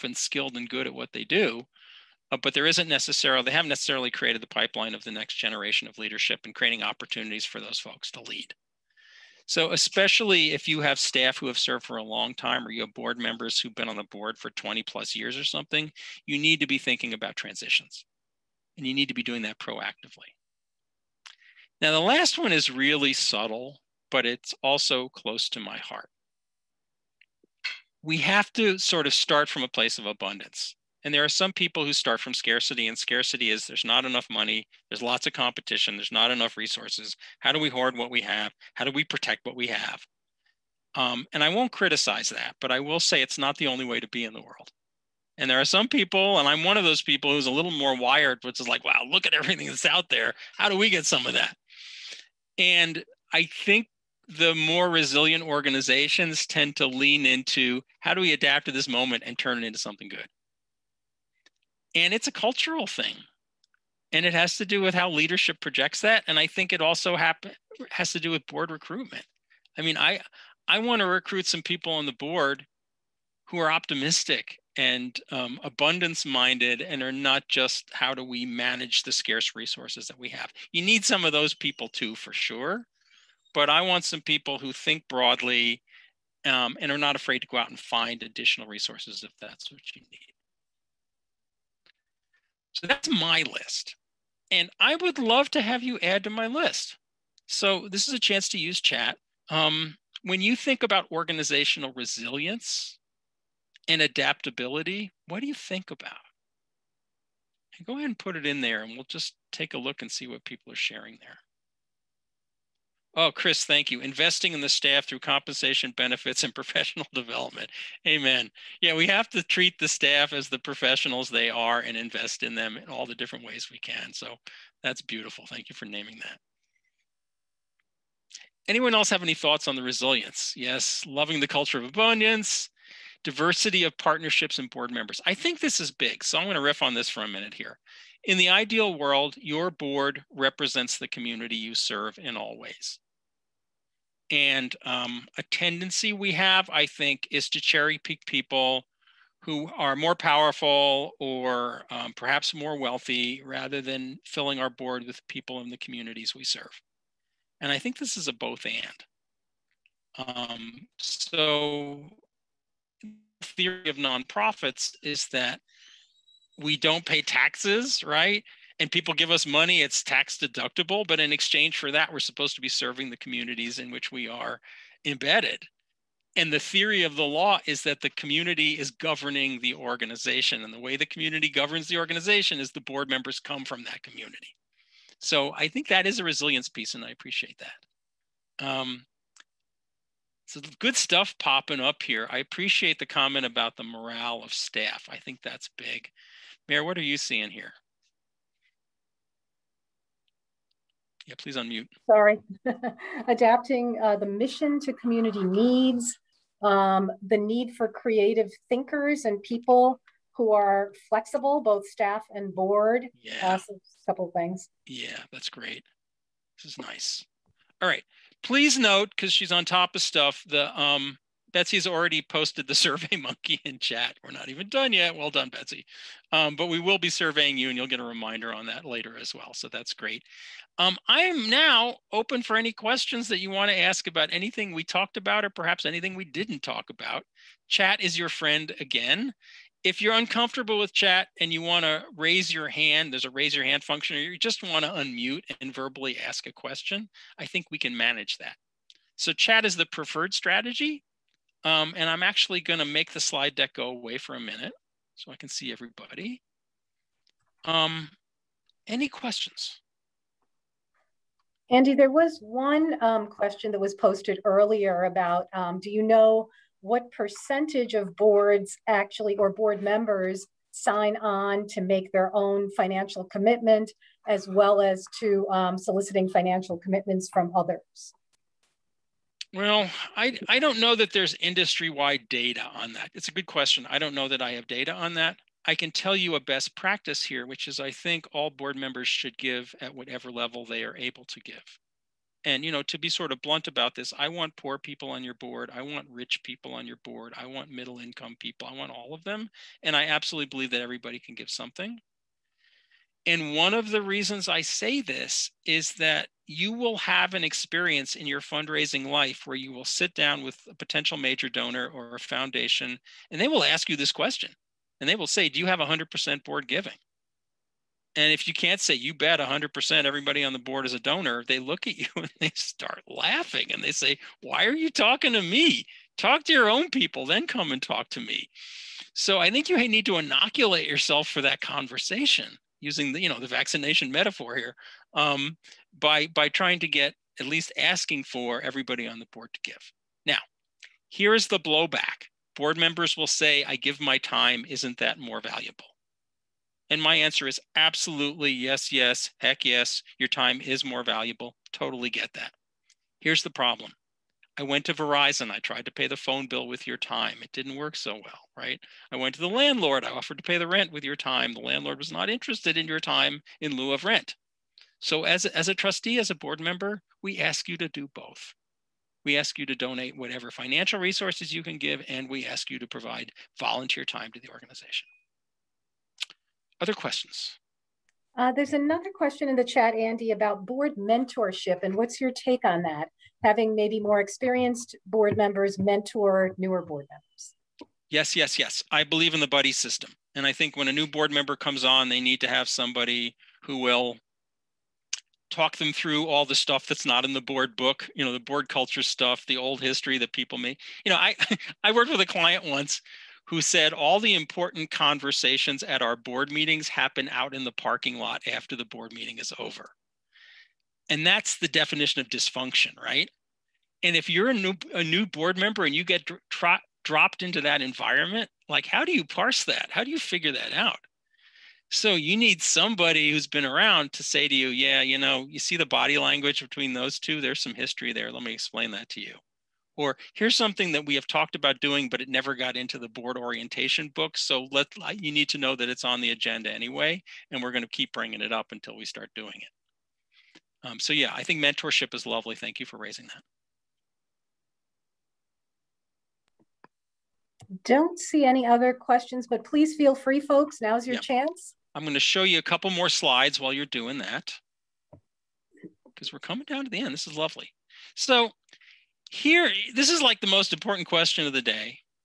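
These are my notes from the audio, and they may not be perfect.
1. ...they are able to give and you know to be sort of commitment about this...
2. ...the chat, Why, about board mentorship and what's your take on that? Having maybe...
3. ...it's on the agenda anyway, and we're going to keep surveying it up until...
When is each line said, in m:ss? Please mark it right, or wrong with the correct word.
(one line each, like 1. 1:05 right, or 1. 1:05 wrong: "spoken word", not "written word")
1. 4:50 wrong: "blunt", not "commitment"
2. 6:19 wrong: "Andy", not "Why"
3. 7:15 wrong: "bringing", not "surveying".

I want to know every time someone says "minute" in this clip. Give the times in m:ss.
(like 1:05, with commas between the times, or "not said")
2:17, 4:14.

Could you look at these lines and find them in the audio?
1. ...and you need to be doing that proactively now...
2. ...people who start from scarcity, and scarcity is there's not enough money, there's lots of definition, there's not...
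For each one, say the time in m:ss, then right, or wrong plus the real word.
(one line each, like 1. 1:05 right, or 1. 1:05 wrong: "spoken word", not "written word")
1. 0:18 right
2. 0:31 wrong: "competition", not "definition".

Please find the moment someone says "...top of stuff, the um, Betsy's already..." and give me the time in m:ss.
3:39.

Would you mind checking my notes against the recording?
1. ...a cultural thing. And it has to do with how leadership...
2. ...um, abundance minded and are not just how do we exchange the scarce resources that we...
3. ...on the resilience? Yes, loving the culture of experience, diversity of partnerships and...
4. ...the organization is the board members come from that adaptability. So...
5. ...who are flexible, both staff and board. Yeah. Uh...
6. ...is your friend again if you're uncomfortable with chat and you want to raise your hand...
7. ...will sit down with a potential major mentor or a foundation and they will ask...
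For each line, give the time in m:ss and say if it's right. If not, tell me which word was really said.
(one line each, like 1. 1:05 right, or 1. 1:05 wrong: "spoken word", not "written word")
1. 1:02 right
2. 1:15 wrong: "manage", not "exchange"
3. 2:09 wrong: "abundance", not "experience"
4. 3:01 wrong: "community", not "adaptability"
5. 3:30 right
6. 3:57 right
7. 5:09 wrong: "donor", not "mentor".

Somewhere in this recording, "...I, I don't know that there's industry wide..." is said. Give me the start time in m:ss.
4:40.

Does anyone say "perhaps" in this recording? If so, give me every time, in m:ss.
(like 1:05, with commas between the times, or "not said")
2:32, 3:55.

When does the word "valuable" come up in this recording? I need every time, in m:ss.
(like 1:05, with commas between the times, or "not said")
5:45, 5:51.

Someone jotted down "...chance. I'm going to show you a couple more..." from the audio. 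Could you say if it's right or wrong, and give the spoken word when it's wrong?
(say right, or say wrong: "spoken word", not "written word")
right.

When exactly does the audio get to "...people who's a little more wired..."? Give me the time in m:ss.
0:47.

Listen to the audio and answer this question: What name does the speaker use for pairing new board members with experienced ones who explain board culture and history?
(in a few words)
the buddy system.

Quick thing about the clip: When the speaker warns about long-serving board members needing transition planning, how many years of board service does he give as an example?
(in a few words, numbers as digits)
20 plus years.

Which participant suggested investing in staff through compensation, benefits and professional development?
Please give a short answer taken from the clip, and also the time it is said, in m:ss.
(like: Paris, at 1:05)
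Chris, at 1:53.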